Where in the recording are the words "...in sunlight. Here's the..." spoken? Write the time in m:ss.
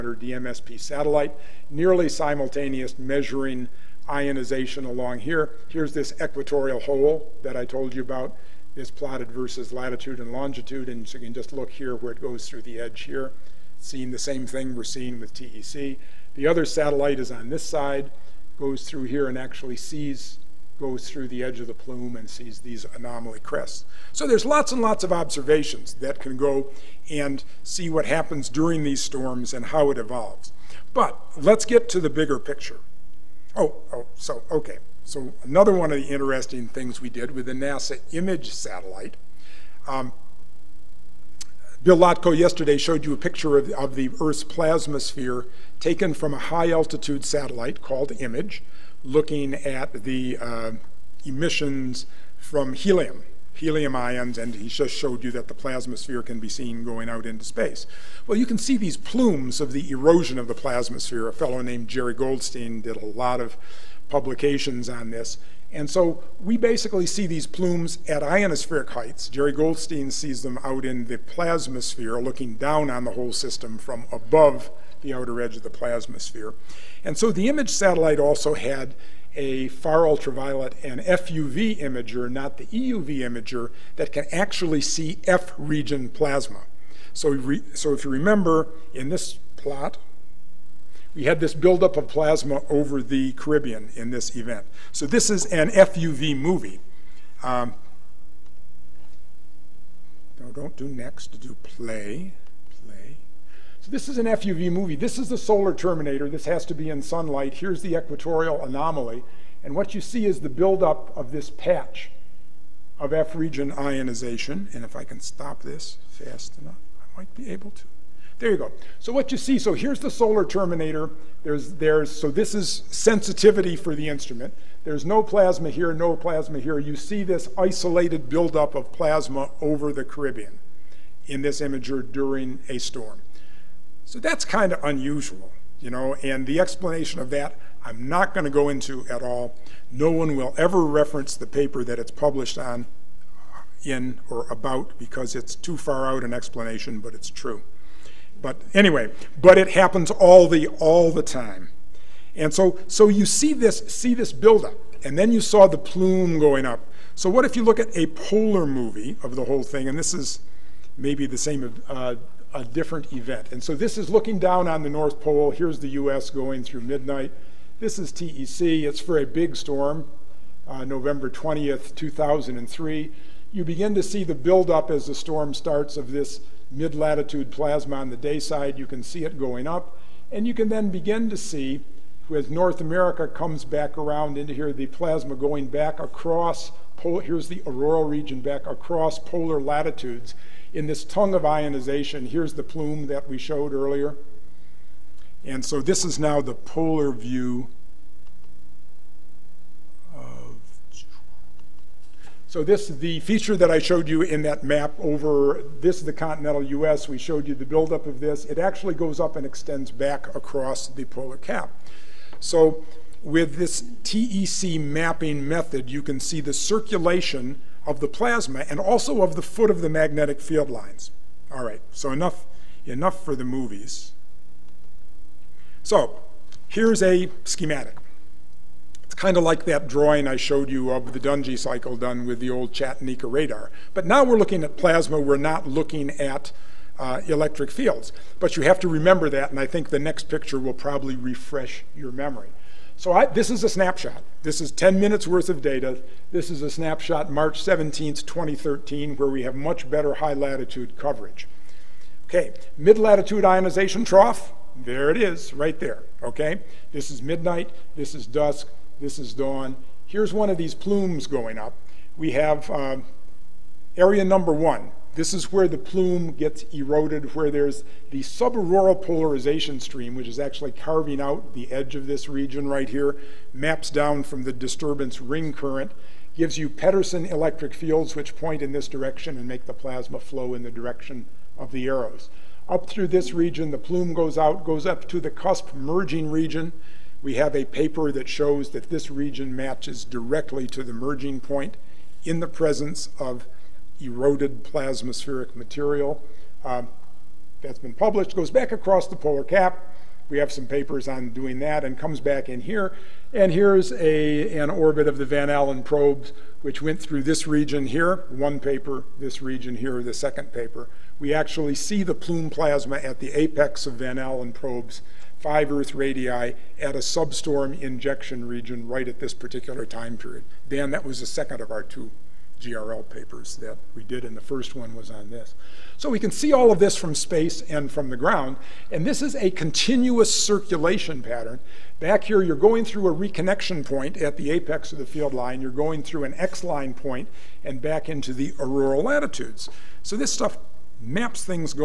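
1:46.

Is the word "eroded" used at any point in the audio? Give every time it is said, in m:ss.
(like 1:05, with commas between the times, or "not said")
4:26, 4:53.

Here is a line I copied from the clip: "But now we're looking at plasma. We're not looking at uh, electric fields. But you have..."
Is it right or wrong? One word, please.
right.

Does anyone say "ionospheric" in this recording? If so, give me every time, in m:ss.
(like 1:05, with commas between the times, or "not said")
1:08.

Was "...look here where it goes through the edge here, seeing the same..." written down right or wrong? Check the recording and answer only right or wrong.
right.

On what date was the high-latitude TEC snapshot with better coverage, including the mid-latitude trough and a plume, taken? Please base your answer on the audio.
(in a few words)
March 17th, 2013.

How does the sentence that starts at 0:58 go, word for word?
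Well, you can see these plumes of the erosion of the plasmasphere.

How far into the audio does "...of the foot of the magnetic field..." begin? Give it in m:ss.
3:39.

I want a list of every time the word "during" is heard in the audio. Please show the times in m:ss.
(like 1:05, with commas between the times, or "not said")
0:28, 2:12.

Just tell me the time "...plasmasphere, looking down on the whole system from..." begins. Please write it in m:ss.
1:11.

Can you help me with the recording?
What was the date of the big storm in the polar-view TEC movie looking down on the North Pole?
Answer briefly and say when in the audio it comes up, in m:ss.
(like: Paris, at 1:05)
November 20th, 2003, at 2:50.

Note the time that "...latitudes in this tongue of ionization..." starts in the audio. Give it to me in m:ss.
3:09.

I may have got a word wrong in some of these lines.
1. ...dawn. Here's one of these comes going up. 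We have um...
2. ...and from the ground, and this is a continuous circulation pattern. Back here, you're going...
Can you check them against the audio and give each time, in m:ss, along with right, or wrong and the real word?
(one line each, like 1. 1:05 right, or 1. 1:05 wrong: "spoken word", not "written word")
1. 4:19 wrong: "plumes", not "comes"
2. 5:27 right.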